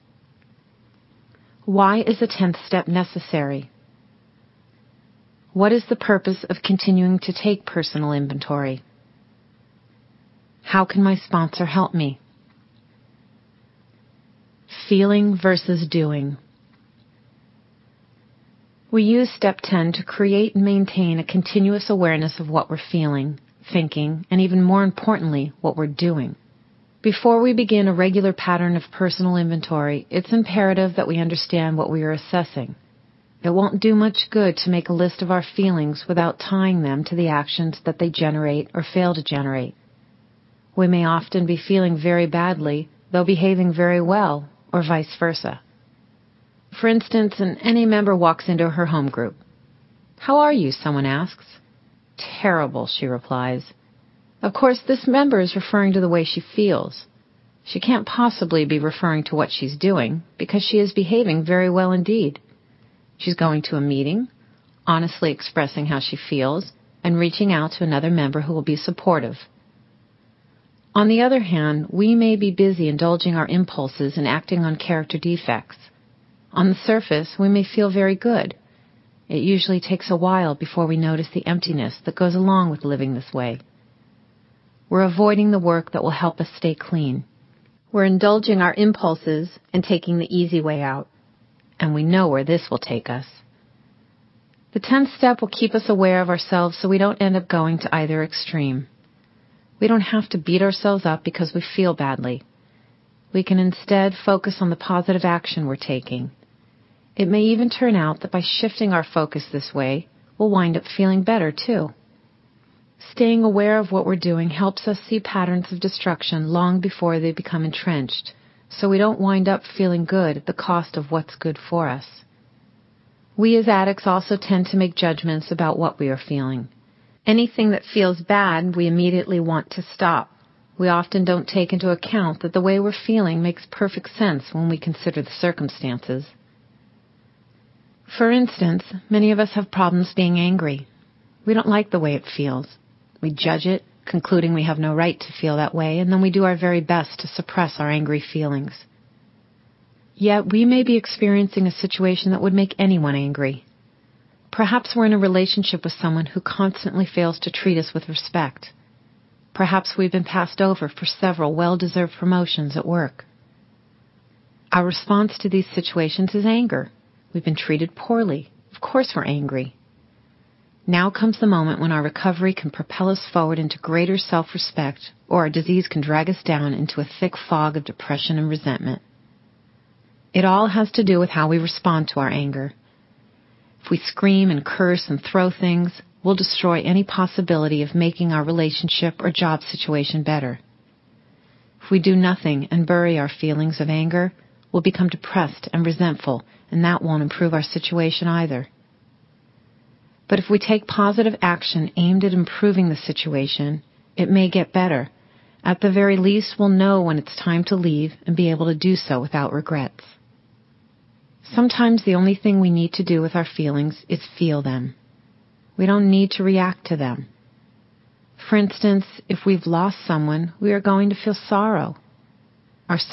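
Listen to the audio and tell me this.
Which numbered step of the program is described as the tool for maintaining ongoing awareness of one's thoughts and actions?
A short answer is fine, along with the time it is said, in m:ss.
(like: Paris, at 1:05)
10th step, at 0:19.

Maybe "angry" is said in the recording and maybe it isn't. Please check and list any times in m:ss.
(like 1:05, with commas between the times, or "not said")
2:20, 2:27, 2:33, 2:49.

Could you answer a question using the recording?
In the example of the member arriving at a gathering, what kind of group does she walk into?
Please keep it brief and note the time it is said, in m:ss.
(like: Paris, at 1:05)
Home group, at 0:48.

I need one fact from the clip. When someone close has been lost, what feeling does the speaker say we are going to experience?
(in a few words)
Sorrow.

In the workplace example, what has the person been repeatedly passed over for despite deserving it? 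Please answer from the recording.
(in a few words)
Promotions.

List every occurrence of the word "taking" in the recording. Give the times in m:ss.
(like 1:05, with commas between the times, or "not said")
1:29, 1:45.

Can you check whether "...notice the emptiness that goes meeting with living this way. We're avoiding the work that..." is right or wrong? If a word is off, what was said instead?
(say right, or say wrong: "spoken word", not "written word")
wrong: "along", not "meeting".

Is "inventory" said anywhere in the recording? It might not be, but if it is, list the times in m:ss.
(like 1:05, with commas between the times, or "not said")
0:08, 0:29.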